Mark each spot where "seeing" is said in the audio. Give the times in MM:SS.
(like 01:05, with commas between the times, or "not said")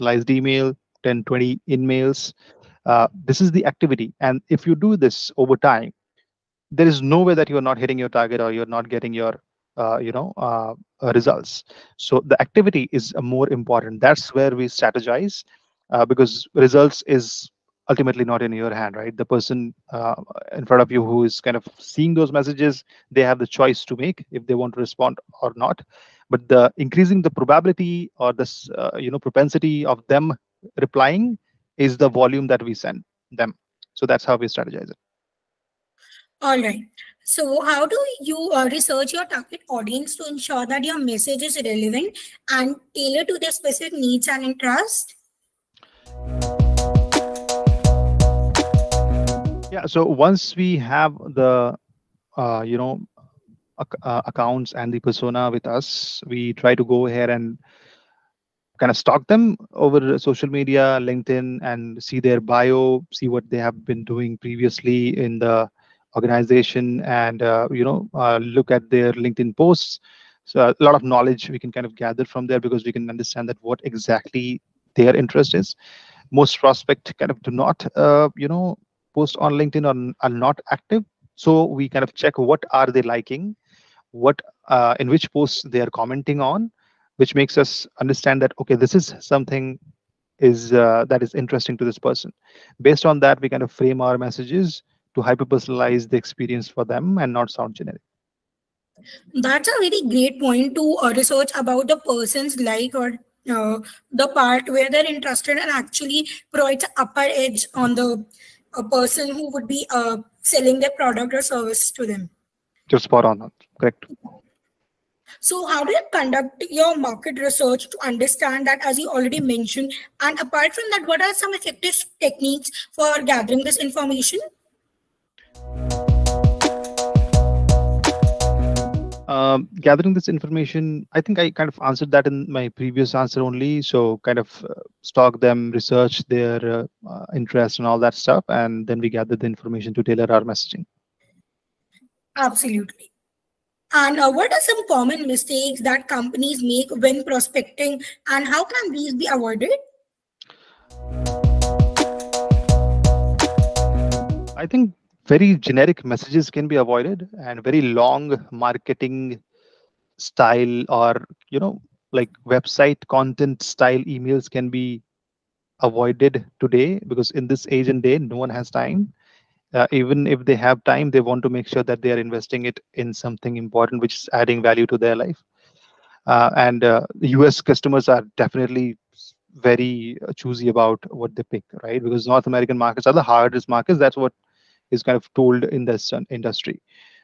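00:21.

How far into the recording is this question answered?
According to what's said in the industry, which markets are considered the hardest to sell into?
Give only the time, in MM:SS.
03:02.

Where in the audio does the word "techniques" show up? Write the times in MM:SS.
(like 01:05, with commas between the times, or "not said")
02:02.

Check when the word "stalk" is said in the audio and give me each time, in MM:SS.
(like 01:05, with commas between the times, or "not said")
00:58, 02:15.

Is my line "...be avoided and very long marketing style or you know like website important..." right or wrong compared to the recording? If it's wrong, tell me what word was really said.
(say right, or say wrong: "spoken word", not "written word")
wrong: "content", not "important".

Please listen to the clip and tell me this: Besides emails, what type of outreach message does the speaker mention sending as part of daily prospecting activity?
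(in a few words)
in-mails.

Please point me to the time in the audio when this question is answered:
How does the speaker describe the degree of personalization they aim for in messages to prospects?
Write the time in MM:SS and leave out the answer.
01:35.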